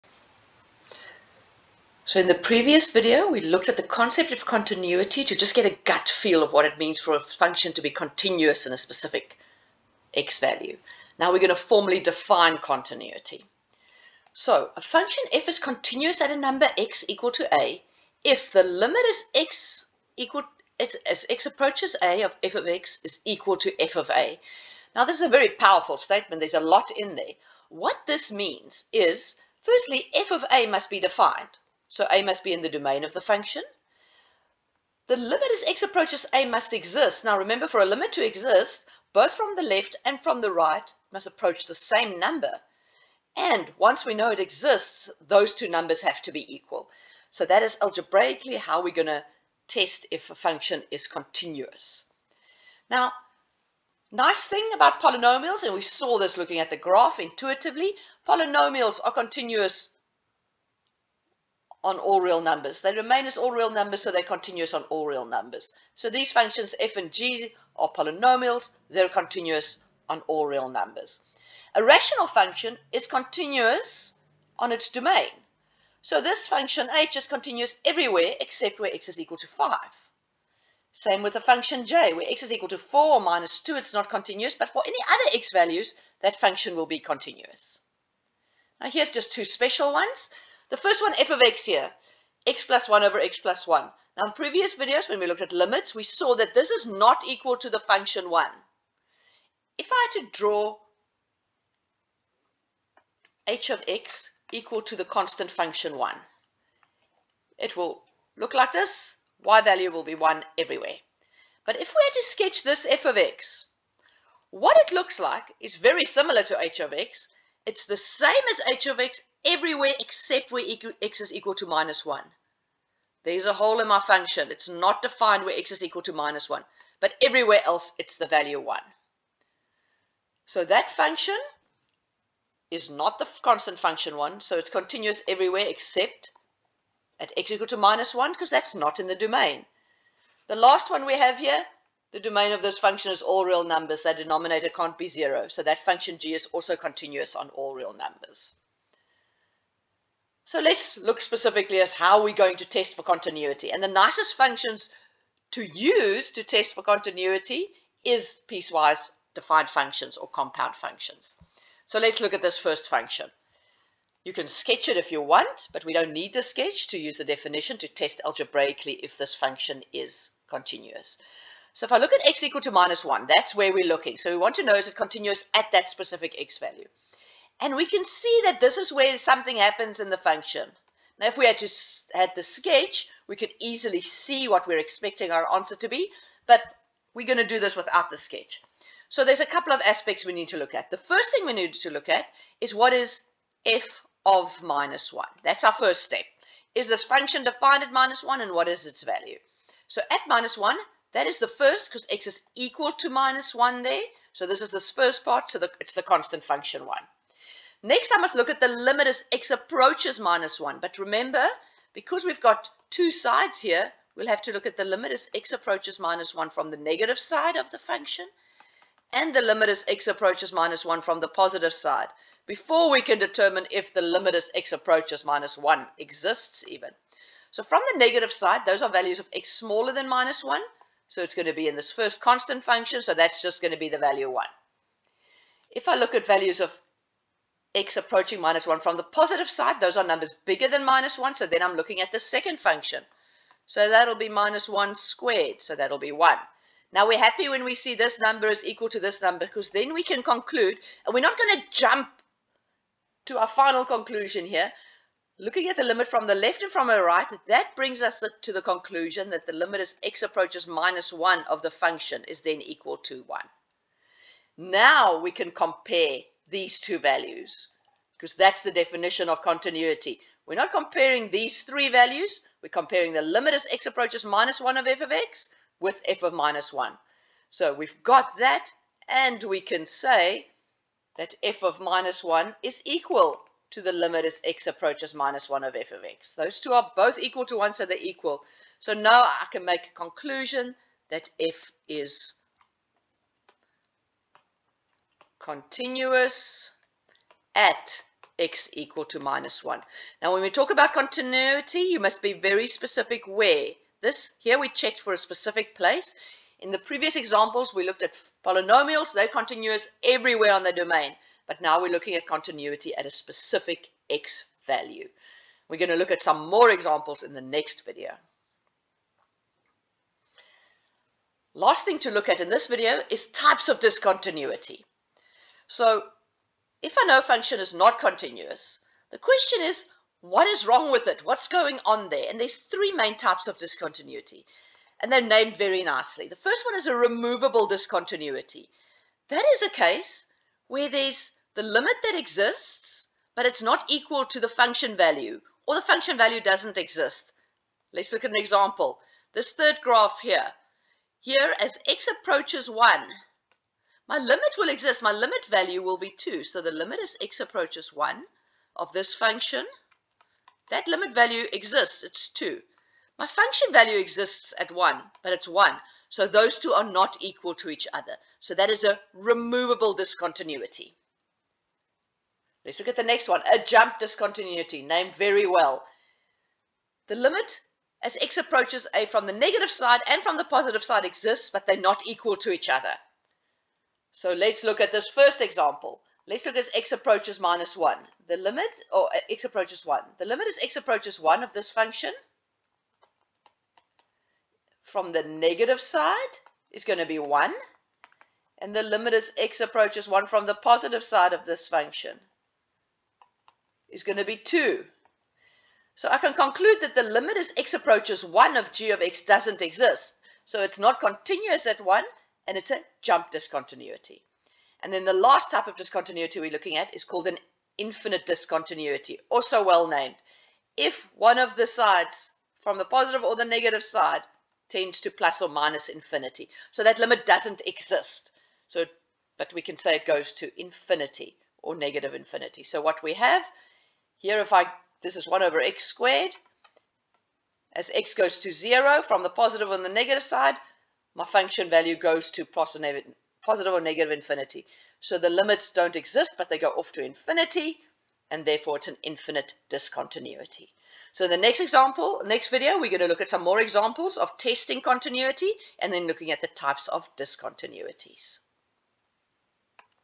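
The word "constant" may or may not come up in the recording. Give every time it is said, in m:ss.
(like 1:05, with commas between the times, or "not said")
1:45, 2:13, 3:26, 3:52.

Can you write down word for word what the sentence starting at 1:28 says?
Now here's just two special ones.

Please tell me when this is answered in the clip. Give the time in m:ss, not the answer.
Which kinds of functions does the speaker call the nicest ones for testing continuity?
2:38.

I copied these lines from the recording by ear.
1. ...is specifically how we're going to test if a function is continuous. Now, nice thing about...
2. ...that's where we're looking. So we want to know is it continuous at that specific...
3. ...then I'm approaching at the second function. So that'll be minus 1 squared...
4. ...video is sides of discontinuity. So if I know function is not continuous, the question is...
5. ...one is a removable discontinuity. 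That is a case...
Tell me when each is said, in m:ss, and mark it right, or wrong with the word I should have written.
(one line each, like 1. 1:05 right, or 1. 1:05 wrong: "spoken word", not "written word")
1. 0:47 wrong: "algebraically", not "specifically"
2. 2:53 right
3. 4:01 wrong: "looking", not "approaching"
4. 5:22 wrong: "types", not "sides"
5. 5:36 right.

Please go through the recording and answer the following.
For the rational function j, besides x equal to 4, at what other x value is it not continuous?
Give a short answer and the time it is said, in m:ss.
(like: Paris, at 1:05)
-2, at 1:23.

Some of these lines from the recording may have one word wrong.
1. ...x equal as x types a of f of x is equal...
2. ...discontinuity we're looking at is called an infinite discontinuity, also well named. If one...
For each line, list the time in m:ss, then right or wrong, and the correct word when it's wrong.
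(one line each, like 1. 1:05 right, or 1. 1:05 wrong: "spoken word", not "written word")
1. 0:19 wrong: "approaches", not "types"
2. 6:55 right.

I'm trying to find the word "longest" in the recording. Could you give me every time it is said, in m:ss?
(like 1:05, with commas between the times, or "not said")
not said.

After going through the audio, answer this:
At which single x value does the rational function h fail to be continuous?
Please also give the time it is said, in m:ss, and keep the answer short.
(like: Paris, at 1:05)
5, at 1:19.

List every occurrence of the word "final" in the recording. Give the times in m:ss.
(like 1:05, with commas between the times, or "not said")
4:13.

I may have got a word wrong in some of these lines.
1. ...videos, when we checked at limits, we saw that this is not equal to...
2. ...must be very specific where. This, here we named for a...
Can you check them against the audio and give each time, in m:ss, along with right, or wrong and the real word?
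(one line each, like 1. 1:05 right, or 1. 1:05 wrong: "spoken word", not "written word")
1. 1:34 wrong: "looked", not "checked"
2. 5:02 wrong: "checked", not "named".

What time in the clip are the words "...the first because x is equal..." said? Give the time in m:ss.
3:21.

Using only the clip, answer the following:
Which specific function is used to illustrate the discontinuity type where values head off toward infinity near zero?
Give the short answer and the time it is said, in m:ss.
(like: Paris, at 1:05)
1 over x squared, at 7:15.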